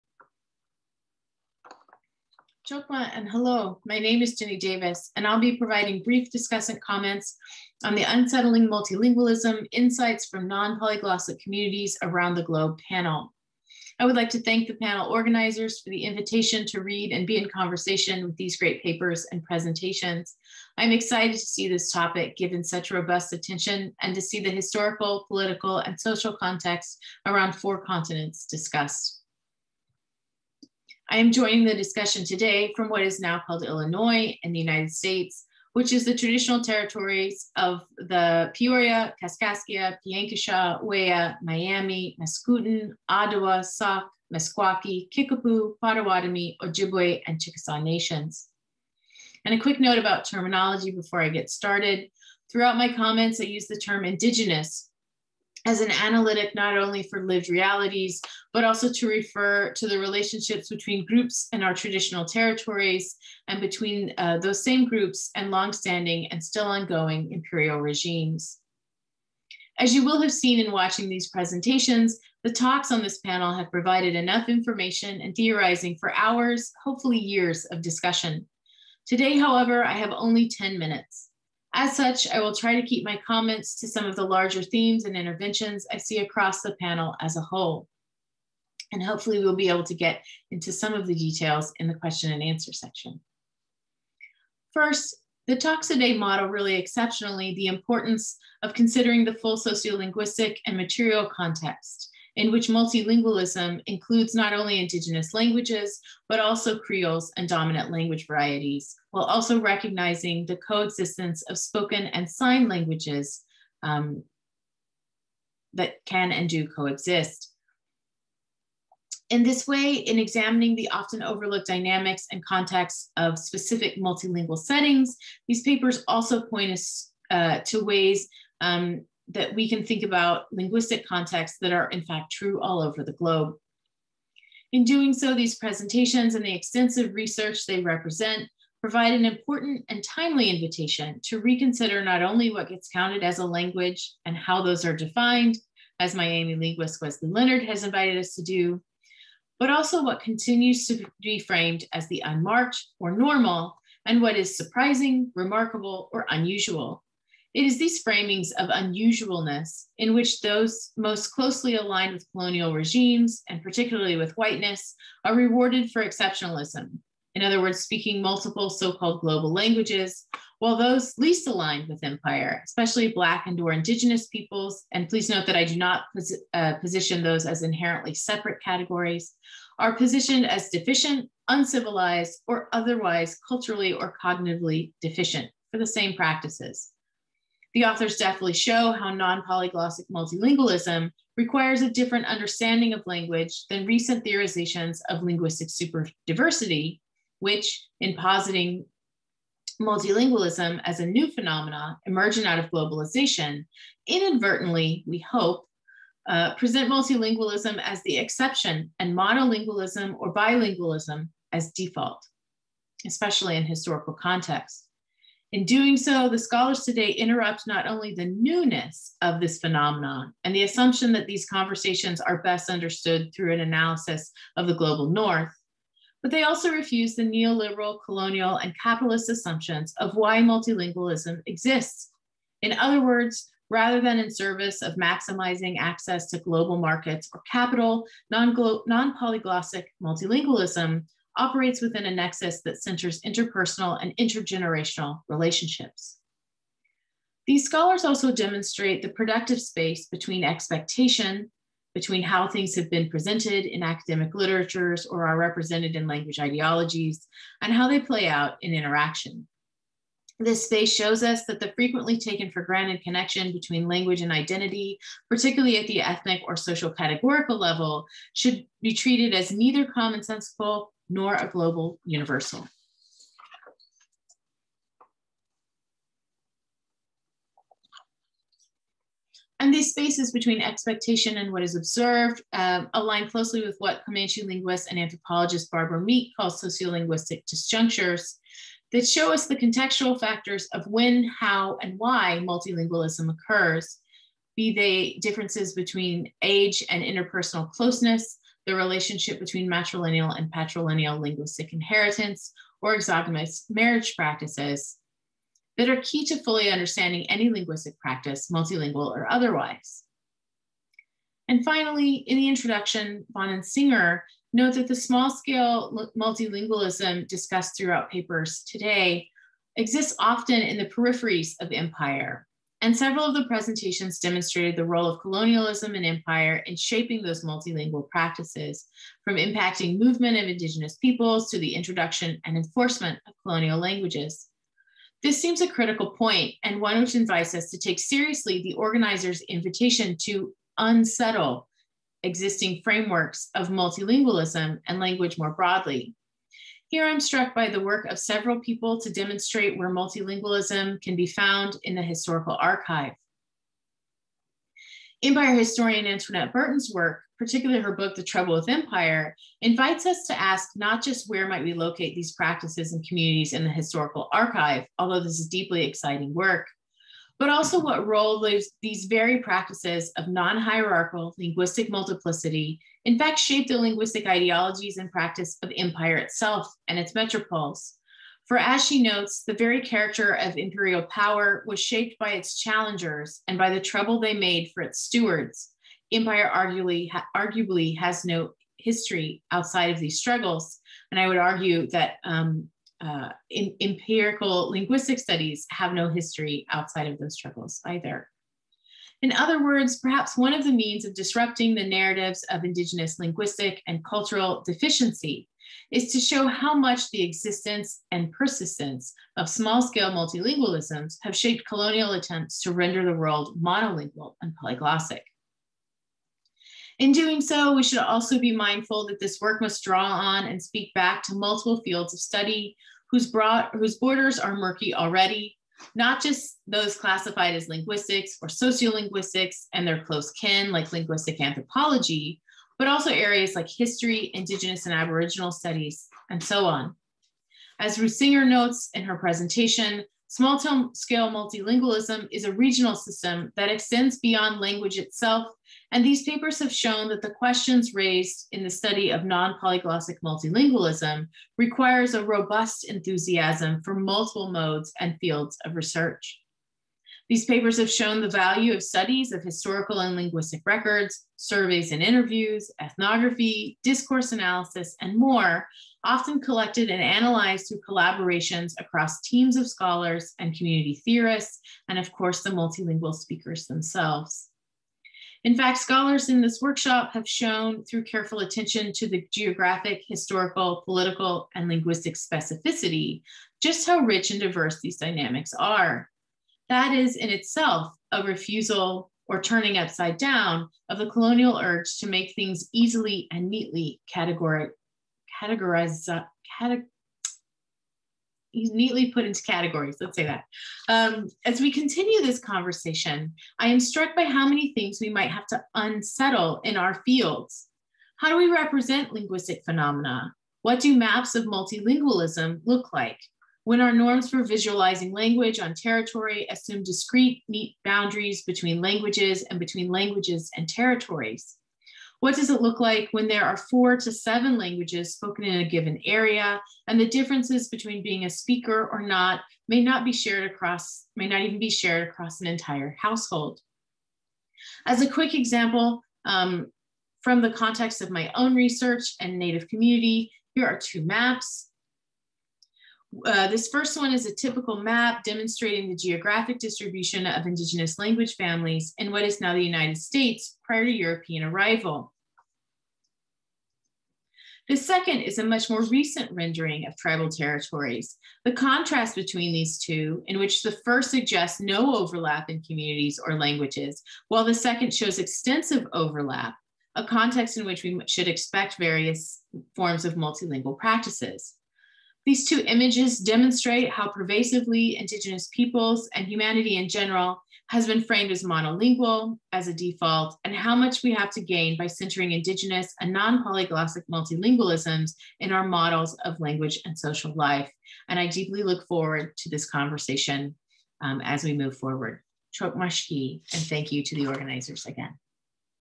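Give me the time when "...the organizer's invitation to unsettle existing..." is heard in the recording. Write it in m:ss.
5:38.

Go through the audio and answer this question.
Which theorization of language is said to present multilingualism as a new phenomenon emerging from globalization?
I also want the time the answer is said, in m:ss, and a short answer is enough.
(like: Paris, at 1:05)
linguistic superdiversity, at 3:15.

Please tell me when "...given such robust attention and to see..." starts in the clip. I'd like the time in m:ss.
0:22.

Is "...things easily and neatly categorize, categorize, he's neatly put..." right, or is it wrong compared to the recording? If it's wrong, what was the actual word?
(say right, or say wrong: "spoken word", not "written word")
right.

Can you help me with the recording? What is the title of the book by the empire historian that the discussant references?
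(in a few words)
The Trouble with Empire.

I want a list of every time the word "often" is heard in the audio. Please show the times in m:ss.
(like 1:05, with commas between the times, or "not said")
2:00, 5:20, 7:46.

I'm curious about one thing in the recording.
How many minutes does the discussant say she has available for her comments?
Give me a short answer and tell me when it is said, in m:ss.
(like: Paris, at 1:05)
10, at 1:20.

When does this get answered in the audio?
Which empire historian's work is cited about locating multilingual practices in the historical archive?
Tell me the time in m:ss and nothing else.
5:56.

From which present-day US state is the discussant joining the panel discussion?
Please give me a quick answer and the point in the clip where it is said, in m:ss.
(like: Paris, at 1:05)
Illinois, at 0:33.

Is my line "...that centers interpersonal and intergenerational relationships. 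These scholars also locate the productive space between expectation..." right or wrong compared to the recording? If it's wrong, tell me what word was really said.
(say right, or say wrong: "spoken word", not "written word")
wrong: "demonstrate", not "locate".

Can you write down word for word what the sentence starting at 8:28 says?
How do we represent linguistic phenomena?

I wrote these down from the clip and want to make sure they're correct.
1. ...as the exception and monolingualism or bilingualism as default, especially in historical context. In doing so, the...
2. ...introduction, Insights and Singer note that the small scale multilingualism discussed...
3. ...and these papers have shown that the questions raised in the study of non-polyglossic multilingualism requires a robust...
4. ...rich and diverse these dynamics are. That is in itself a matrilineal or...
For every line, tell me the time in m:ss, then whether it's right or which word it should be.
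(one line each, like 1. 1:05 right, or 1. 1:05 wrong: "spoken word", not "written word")
1. 3:27 right
2. 5:12 wrong: "Vaughan", not "Insights"
3. 7:25 right
4. 8:03 wrong: "refusal", not "matrilineal".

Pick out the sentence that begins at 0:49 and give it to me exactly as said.
And a quick note about terminology before I get started.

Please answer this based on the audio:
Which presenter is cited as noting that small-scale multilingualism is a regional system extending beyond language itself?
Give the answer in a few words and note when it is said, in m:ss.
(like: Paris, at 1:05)
Ruth Singer, at 7:17.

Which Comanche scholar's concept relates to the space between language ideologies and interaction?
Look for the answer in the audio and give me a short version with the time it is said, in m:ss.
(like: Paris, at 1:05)
Barbara Meek, at 4:45.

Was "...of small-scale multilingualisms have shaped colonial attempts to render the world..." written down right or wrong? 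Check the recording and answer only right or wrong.
right.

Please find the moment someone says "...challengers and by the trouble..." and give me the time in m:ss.
6:22.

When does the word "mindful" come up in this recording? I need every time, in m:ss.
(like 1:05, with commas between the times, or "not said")
6:58.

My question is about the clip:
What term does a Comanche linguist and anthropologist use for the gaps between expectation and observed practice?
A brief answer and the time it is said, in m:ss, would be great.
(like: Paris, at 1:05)
sociolinguistic disjunctures, at 4:46.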